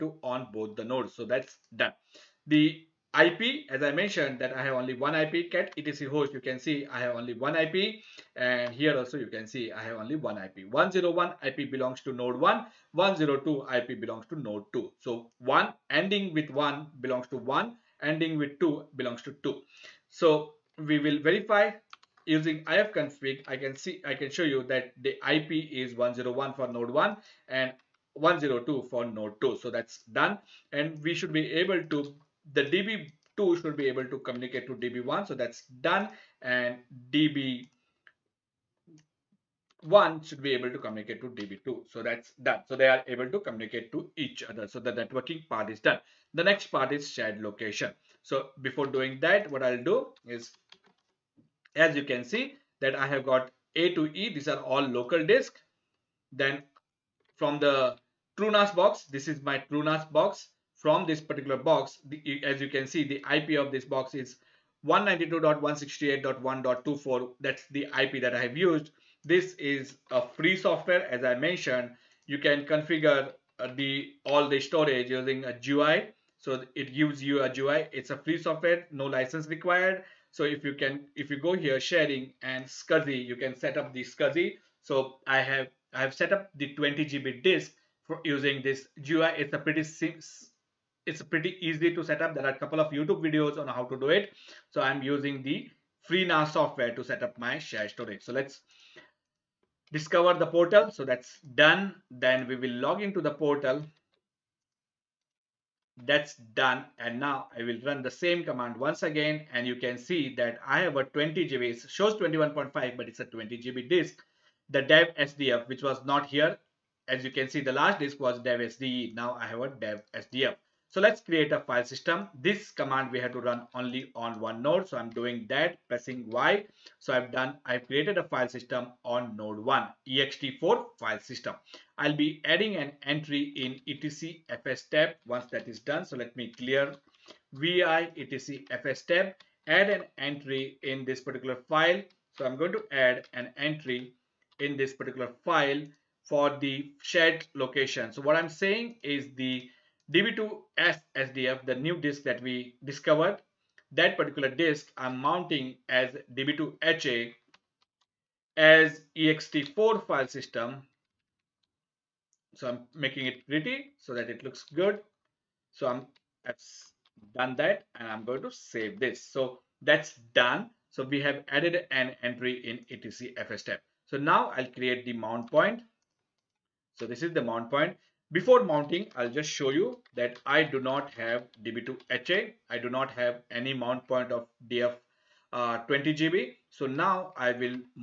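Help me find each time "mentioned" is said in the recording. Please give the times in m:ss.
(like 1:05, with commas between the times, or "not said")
0:03, 1:11.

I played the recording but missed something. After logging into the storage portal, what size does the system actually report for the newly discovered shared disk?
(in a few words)
21.5.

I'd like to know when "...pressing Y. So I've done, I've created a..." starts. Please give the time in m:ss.
2:05.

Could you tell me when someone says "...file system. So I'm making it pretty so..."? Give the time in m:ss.
2:40.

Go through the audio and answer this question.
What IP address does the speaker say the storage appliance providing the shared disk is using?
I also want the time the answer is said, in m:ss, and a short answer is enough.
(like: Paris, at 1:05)
192.168.1.24, at 1:04.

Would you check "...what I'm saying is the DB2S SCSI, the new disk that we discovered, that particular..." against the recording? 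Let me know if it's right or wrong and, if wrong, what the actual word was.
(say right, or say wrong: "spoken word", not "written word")
wrong: "SDF", not "SCSI".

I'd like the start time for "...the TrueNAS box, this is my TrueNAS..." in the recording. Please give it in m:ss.
0:57.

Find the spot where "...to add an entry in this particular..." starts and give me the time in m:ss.
2:22.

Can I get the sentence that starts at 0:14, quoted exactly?
So 1 ending with 1 belongs to 1, ending with 2 belongs to 2.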